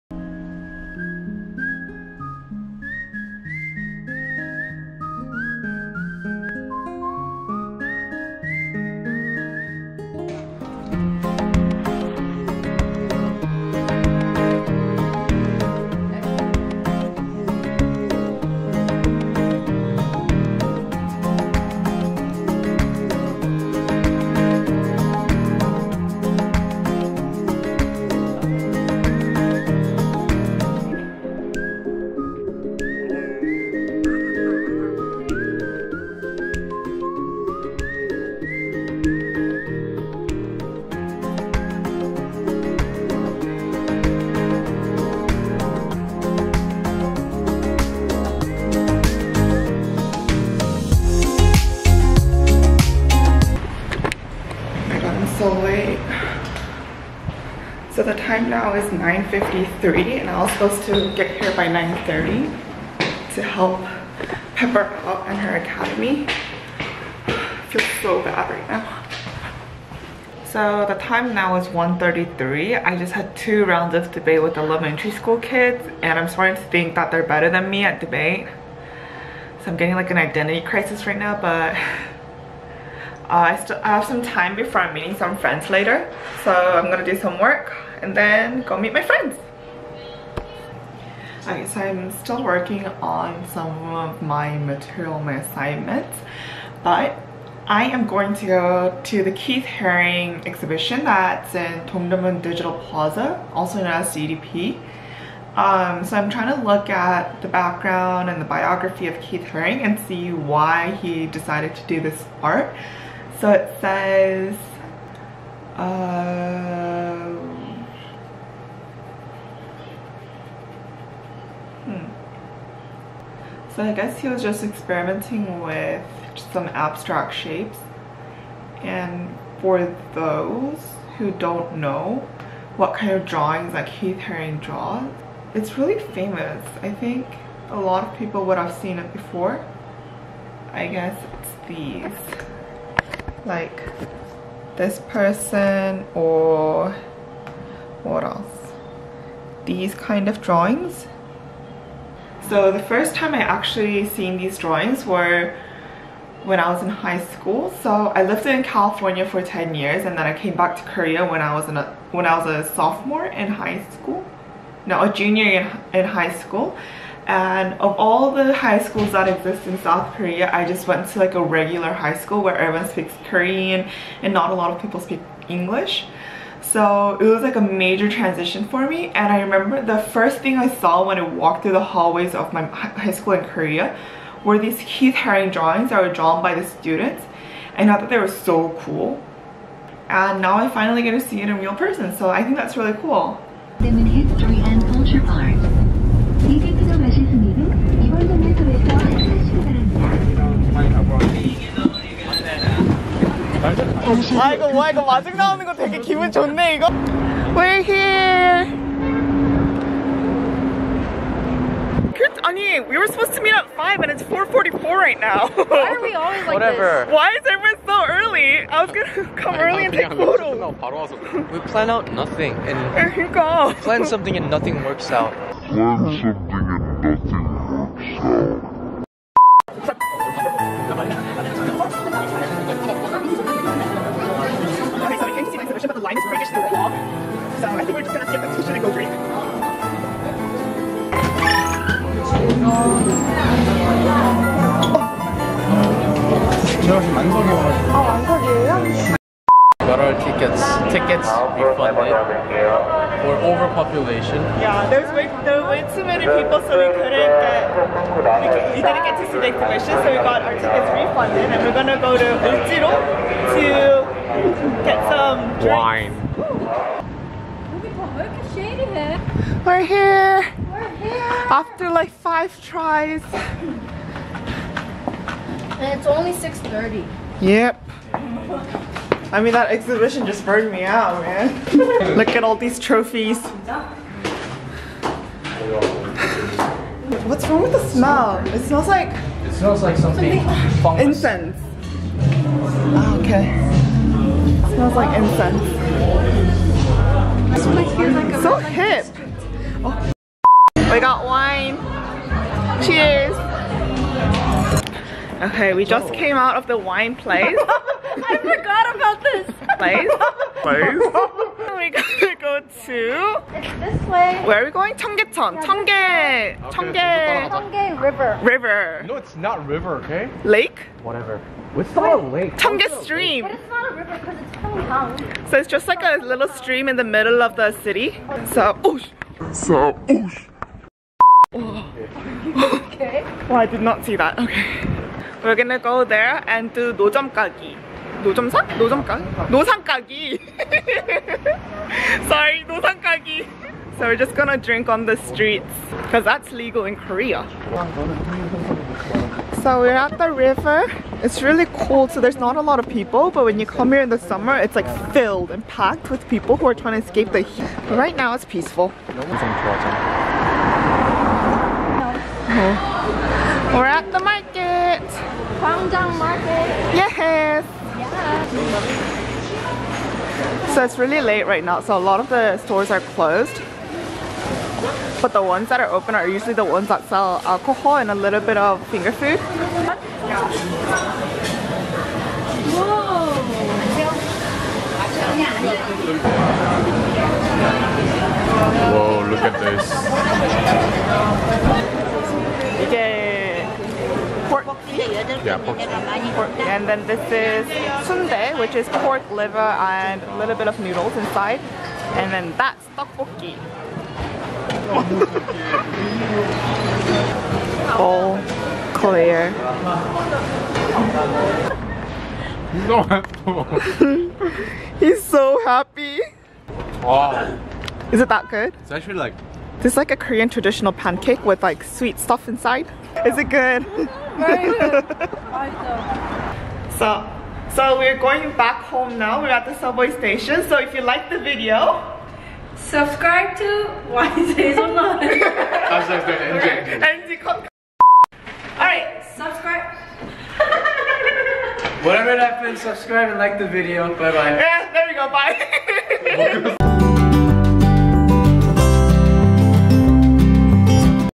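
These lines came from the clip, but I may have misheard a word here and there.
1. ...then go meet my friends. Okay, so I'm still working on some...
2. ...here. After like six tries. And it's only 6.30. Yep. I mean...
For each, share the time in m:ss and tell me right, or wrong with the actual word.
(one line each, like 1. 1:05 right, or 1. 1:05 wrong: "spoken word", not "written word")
1. 1:28 right
2. 4:30 wrong: "five", not "six".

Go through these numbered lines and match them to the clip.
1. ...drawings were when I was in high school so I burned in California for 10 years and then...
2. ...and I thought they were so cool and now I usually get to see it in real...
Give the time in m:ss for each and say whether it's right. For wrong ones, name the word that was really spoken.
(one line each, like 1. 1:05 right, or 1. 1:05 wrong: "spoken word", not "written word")
1. 2:34 wrong: "lived", not "burned"
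2. 3:07 wrong: "finally", not "usually".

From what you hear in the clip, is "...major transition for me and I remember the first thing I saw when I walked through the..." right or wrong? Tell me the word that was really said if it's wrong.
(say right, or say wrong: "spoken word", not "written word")
right.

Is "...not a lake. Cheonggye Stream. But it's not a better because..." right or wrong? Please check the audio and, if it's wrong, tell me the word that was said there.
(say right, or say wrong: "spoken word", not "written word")
wrong: "river", not "better".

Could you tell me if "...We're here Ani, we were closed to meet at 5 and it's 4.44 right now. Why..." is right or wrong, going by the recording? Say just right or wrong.
wrong.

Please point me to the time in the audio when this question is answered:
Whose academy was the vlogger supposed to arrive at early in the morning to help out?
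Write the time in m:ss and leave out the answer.
1:04.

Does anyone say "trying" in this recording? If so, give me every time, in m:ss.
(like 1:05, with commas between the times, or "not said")
1:46, 5:56.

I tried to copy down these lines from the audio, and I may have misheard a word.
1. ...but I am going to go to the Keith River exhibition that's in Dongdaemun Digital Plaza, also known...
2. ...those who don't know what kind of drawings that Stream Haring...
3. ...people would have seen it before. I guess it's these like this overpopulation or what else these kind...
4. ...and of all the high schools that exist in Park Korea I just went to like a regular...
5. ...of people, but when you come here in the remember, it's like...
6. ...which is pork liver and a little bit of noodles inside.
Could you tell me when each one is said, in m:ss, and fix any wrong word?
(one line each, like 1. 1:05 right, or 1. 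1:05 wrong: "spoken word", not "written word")
1. 1:36 wrong: "Haring", not "River"
2. 2:10 wrong: "Keith", not "Stream"
3. 2:18 wrong: "person", not "overpopulation"
4. 2:47 wrong: "South", not "Park"
5. 5:52 wrong: "summer", not "remember"
6. 6:38 right.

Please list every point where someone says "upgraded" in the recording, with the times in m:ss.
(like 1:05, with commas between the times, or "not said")
not said.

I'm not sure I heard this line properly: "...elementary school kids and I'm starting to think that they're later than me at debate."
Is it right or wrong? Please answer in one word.
wrong.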